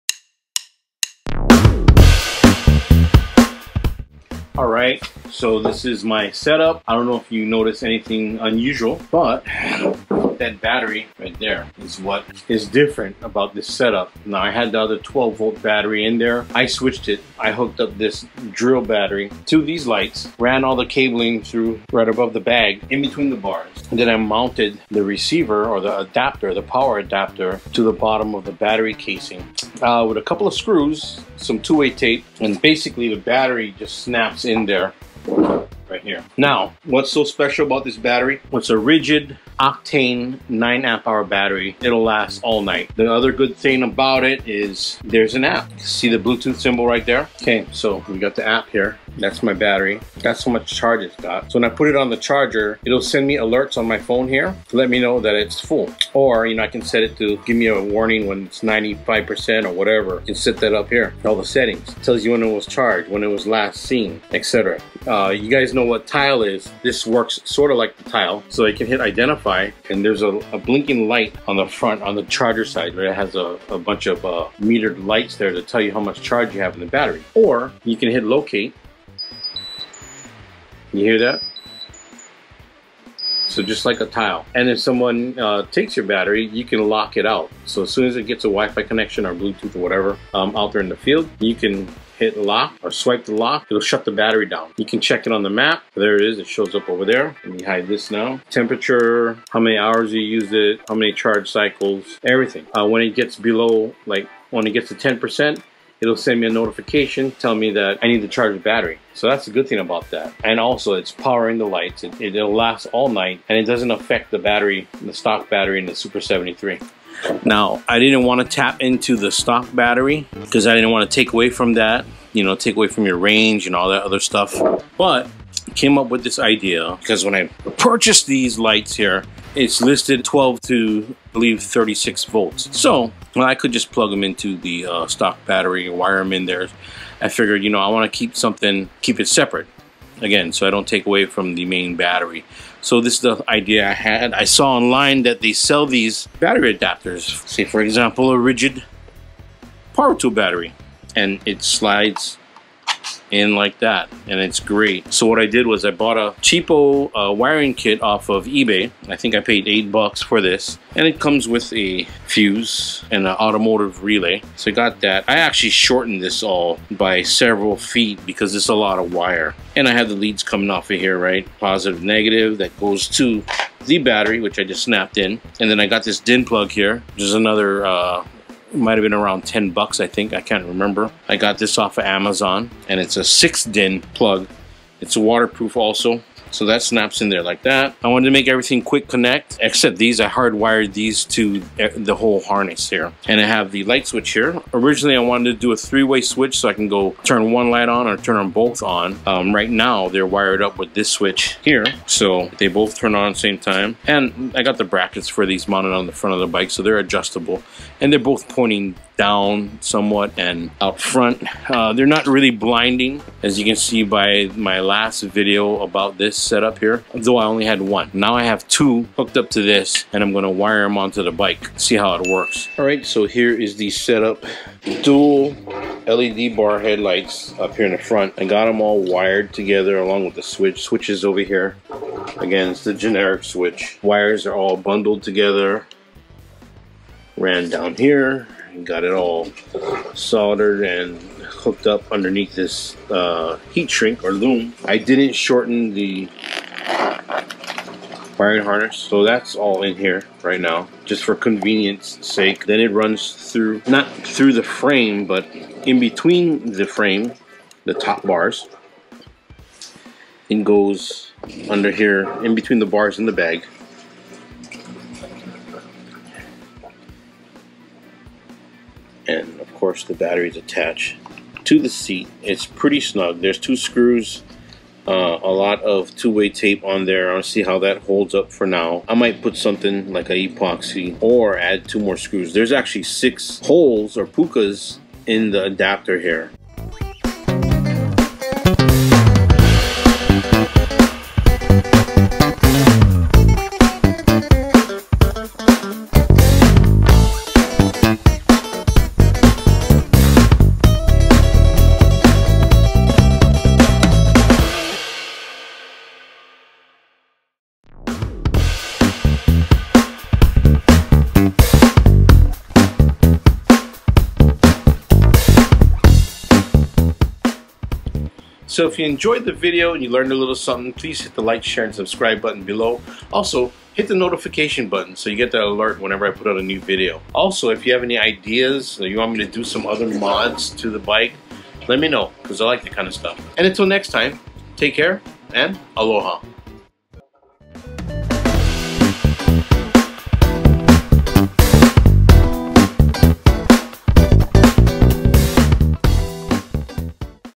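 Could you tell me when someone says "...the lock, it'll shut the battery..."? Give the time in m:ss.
1:33.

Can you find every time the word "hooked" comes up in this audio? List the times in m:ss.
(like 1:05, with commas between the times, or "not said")
0:17, 3:39, 4:01.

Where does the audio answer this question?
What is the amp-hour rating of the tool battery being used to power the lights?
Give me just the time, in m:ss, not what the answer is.
0:40.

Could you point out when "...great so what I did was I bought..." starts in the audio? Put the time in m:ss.
2:34.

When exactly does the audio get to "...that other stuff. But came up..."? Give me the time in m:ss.
2:03.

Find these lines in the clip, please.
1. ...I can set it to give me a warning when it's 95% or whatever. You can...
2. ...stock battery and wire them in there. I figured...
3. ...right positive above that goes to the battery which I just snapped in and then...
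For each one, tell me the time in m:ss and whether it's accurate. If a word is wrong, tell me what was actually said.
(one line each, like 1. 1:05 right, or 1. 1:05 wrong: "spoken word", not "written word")
1. 0:56 right
2. 2:15 right
3. 2:51 wrong: "negative", not "above".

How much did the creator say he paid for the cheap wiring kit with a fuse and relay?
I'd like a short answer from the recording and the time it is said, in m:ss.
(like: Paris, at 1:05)
8 dollars, at 2:39.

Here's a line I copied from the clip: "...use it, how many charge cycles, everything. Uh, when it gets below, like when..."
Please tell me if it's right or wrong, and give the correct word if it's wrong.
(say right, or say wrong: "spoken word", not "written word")
right.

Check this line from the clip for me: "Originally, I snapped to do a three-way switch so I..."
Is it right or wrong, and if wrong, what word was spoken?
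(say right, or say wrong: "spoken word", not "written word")
wrong: "wanted", not "snapped".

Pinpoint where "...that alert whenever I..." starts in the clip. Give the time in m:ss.
5:25.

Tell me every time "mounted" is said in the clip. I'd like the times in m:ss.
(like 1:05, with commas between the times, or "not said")
0:24, 3:25.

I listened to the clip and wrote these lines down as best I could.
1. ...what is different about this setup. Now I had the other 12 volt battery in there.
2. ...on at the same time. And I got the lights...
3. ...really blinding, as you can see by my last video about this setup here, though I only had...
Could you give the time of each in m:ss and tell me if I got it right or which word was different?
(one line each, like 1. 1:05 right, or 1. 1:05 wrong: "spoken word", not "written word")
1. 0:11 right
2. 3:23 wrong: "brackets", not "lights"
3. 3:32 right.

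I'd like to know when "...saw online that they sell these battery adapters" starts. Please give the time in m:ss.
2:24.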